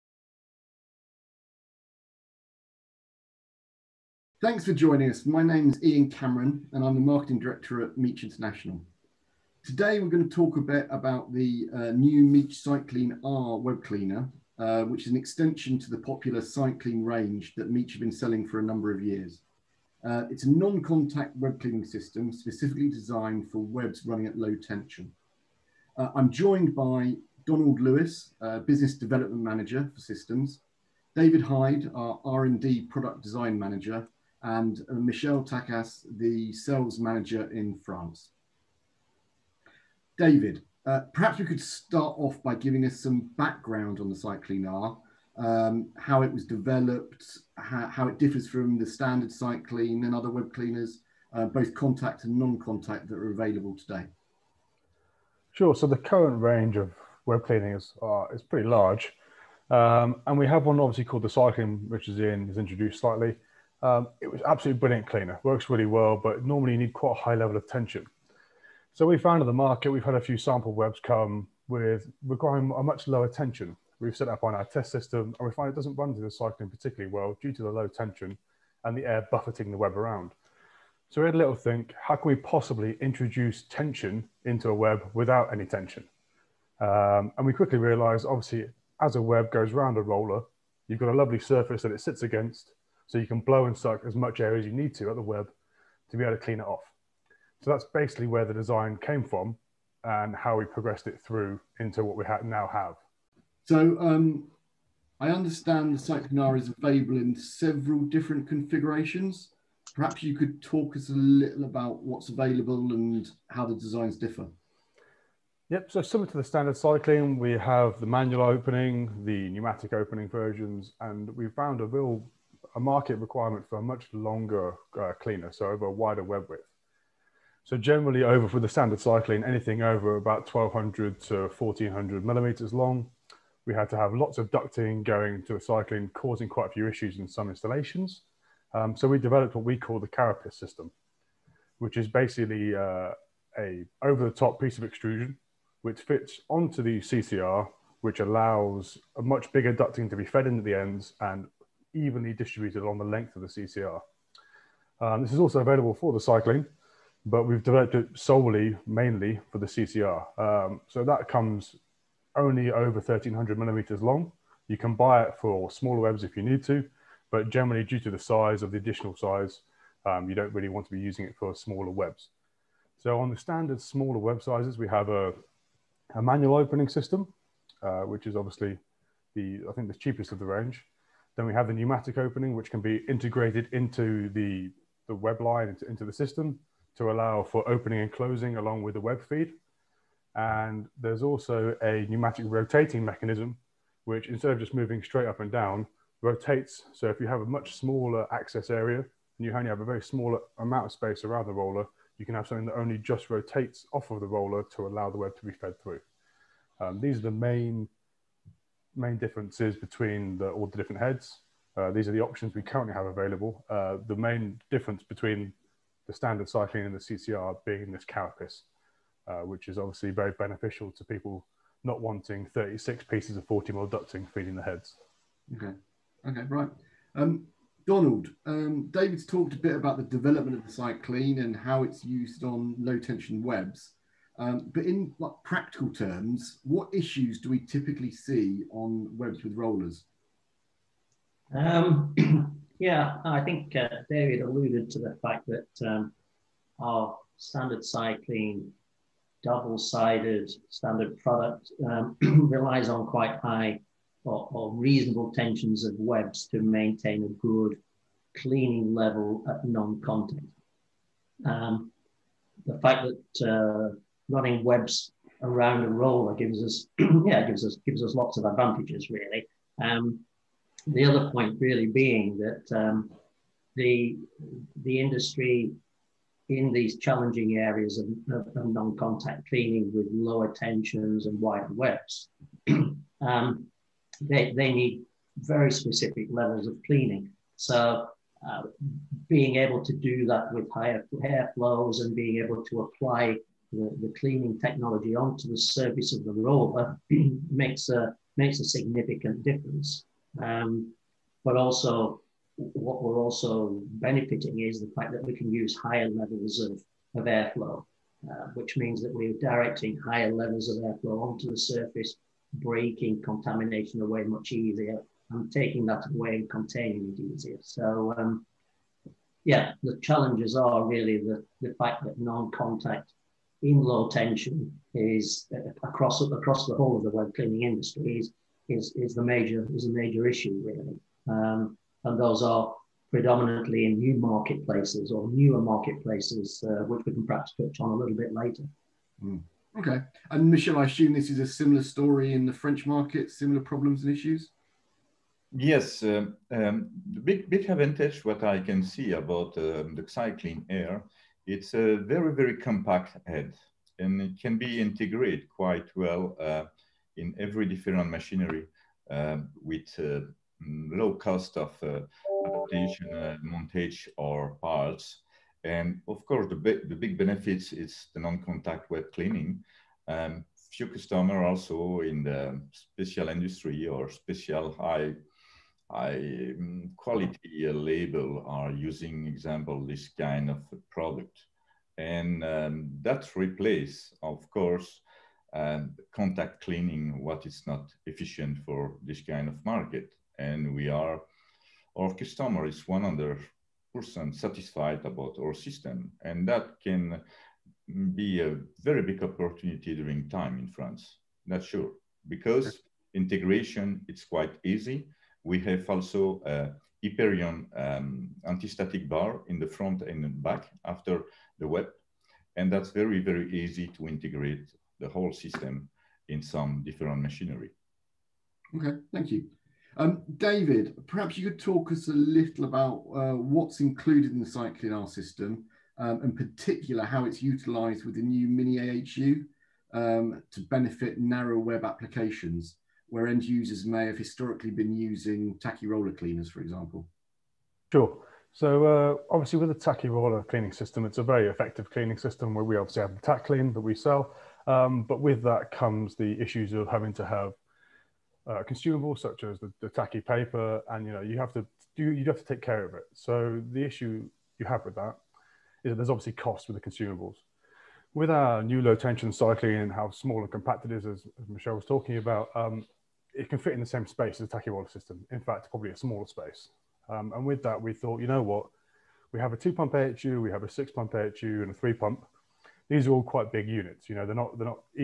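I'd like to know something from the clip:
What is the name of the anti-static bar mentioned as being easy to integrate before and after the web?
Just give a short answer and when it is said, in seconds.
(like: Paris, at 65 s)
Hyperion, at 407 s.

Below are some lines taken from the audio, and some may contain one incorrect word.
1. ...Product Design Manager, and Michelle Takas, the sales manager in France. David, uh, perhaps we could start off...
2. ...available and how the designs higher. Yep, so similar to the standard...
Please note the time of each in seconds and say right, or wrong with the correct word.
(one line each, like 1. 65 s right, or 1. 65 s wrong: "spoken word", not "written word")
1. 32 s right
2. 112 s wrong: "differ", not "higher".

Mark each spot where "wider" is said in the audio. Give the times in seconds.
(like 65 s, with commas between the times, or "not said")
125 s, 281 s.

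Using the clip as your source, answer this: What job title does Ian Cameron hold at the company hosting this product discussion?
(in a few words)
Marketing Director.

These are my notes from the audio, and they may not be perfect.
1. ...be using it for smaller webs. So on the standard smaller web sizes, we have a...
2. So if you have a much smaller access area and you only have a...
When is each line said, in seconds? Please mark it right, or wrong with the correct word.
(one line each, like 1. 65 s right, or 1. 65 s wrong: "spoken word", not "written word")
1. 170 s right
2. 196 s right.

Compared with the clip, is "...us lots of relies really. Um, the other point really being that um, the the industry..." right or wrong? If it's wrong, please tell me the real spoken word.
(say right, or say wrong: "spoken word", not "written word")
wrong: "advantages", not "relies".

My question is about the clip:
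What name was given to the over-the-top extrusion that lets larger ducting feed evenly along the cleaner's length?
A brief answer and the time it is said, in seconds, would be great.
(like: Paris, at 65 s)
carapace system, at 140 s.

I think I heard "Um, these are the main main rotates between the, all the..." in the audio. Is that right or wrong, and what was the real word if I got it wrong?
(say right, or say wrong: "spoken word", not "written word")
wrong: "differences", not "rotates".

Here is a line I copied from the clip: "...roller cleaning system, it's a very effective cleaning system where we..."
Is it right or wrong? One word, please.
right.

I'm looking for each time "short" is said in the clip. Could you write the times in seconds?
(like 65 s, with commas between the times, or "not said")
not said.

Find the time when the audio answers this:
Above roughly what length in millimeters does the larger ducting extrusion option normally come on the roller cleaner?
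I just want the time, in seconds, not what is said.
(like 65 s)
162 s.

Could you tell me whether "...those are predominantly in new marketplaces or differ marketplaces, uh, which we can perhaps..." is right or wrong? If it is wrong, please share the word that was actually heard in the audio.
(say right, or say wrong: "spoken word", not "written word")
wrong: "newer", not "differ".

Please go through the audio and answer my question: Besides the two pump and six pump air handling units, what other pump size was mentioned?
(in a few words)
three pump.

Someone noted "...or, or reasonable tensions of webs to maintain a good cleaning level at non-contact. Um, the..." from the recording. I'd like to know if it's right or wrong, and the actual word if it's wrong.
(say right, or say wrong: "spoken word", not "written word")
right.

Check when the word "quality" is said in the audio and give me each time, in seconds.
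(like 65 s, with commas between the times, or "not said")
376 s.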